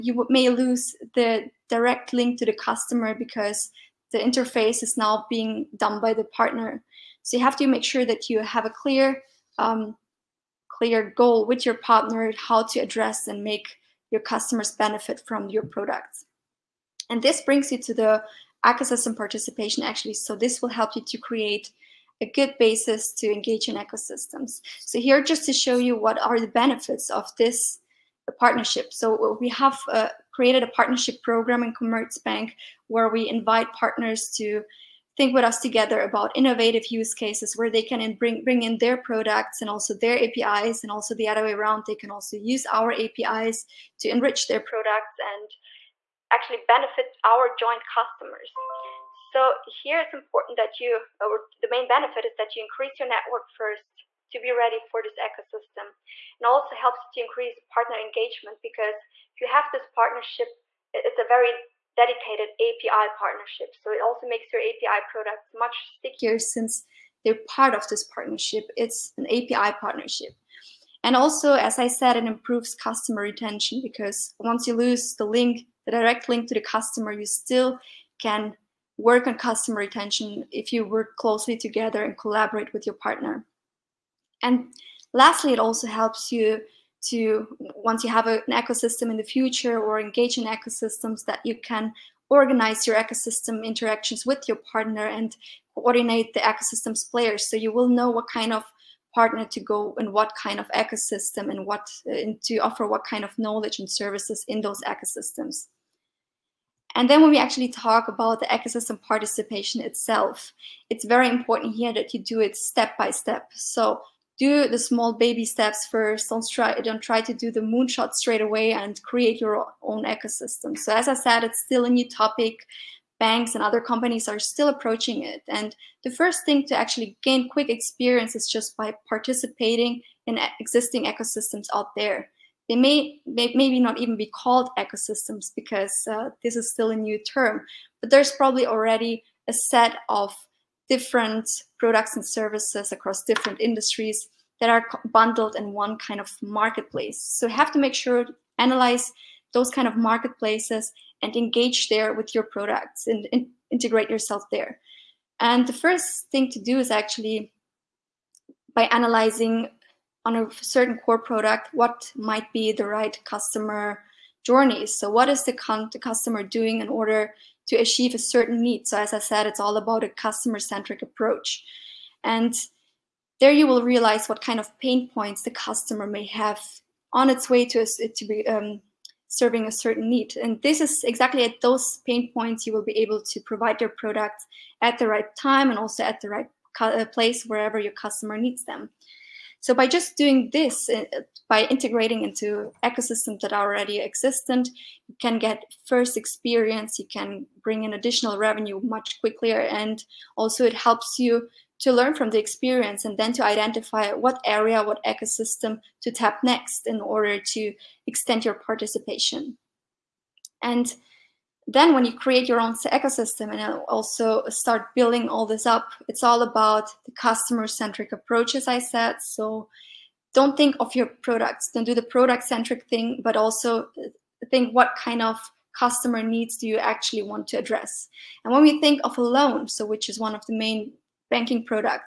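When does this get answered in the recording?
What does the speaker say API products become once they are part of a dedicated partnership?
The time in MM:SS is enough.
01:05.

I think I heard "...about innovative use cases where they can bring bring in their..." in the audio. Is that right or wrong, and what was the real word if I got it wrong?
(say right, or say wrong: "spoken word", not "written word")
right.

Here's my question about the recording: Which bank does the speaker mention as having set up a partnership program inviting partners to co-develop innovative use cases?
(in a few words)
Commerzbank.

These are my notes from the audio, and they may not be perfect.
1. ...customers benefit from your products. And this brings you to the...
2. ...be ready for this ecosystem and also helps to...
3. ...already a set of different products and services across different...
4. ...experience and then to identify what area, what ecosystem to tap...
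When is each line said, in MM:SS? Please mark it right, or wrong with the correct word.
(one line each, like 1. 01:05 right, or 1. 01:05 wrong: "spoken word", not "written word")
1. 00:14 right
2. 00:54 right
3. 02:18 right
4. 03:22 right.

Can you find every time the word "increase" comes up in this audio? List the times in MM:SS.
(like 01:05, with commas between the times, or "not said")
00:52, 00:57.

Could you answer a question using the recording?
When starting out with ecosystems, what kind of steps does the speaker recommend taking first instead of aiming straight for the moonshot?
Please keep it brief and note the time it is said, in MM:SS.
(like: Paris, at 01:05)
Small baby steps, at 01:54.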